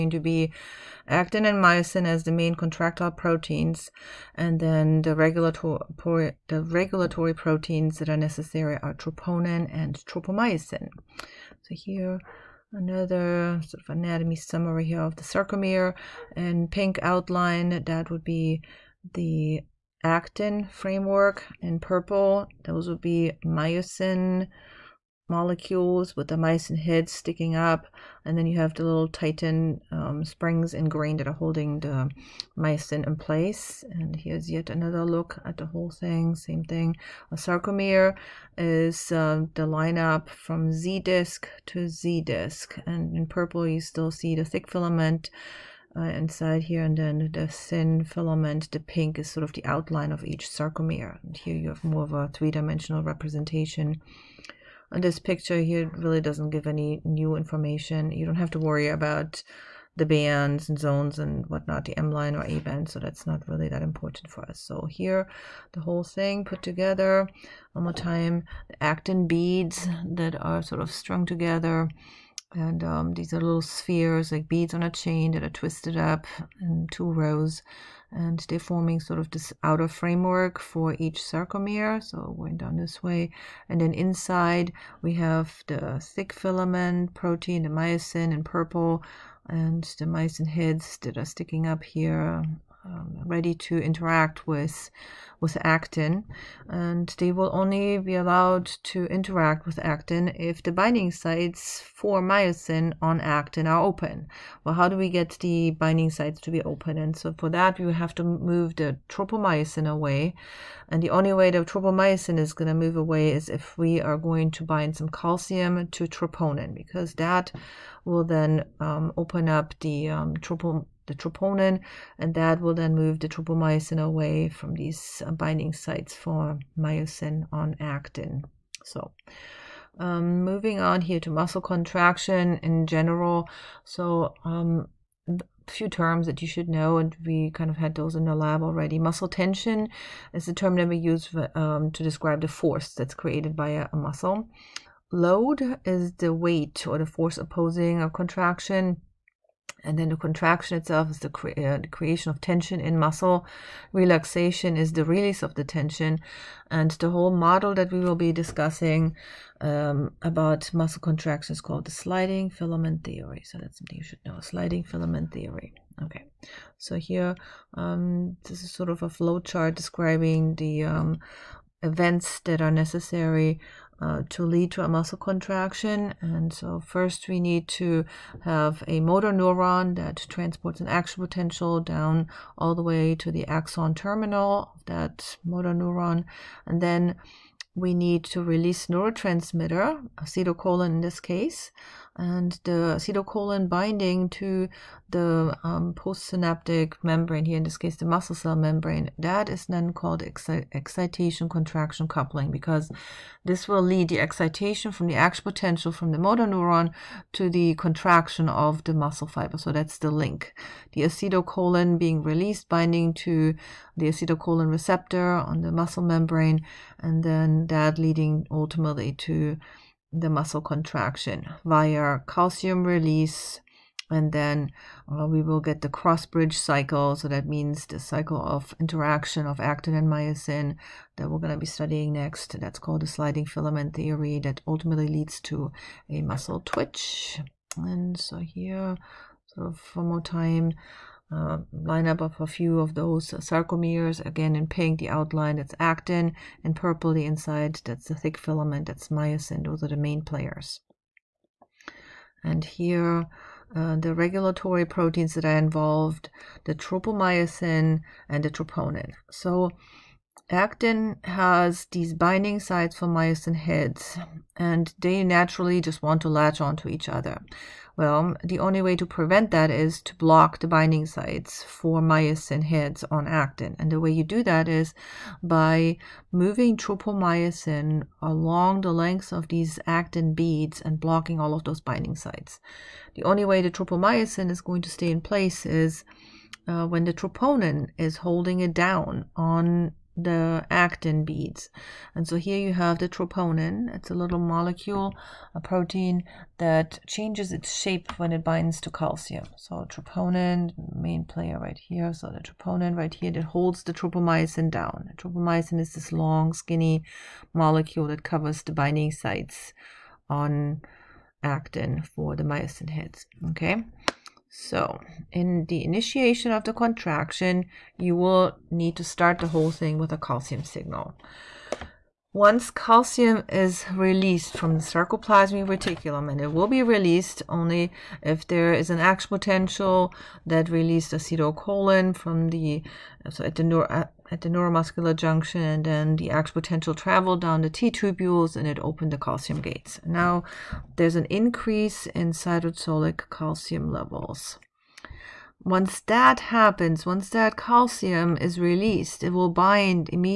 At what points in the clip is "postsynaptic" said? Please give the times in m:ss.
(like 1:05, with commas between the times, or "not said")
3:15.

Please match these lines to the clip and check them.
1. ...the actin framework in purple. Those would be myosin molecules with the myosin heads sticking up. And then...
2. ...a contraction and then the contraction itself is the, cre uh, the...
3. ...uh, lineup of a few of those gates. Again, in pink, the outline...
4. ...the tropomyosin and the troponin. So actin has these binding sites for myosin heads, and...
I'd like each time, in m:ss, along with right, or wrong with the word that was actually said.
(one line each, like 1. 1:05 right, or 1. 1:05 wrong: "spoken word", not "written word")
1. 0:19 right
2. 2:28 right
3. 4:01 wrong: "sarcomeres", not "gates"
4. 4:16 right.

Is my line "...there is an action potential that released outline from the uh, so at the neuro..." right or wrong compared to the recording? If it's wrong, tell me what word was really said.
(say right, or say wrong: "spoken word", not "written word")
wrong: "acetylcholine", not "outline".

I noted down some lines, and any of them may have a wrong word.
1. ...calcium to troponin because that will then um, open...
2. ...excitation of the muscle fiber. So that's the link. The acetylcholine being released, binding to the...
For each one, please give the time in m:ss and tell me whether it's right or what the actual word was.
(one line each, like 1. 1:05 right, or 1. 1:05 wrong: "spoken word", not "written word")
1. 1:55 right
2. 3:27 wrong: "contraction", not "excitation".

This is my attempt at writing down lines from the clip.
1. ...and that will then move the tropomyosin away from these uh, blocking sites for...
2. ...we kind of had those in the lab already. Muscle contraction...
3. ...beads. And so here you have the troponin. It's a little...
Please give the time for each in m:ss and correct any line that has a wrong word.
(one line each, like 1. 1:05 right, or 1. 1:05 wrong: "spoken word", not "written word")
1. 2:02 wrong: "binding", not "blocking"
2. 2:17 wrong: "tension", not "contraction"
3. 4:51 right.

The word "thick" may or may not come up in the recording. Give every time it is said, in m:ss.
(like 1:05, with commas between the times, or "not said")
0:44, 1:25, 4:08.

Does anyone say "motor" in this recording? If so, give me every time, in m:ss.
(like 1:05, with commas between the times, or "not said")
2:59, 3:05, 3:26.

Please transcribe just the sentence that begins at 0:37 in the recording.
A sarcomere is uh, the lineup from Z disc to Z disc.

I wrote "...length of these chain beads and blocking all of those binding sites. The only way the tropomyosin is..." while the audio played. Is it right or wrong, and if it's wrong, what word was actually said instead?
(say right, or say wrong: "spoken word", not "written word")
wrong: "actin", not "chain".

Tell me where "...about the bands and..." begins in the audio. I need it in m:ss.
0:58.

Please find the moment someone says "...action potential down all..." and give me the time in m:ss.
3:00.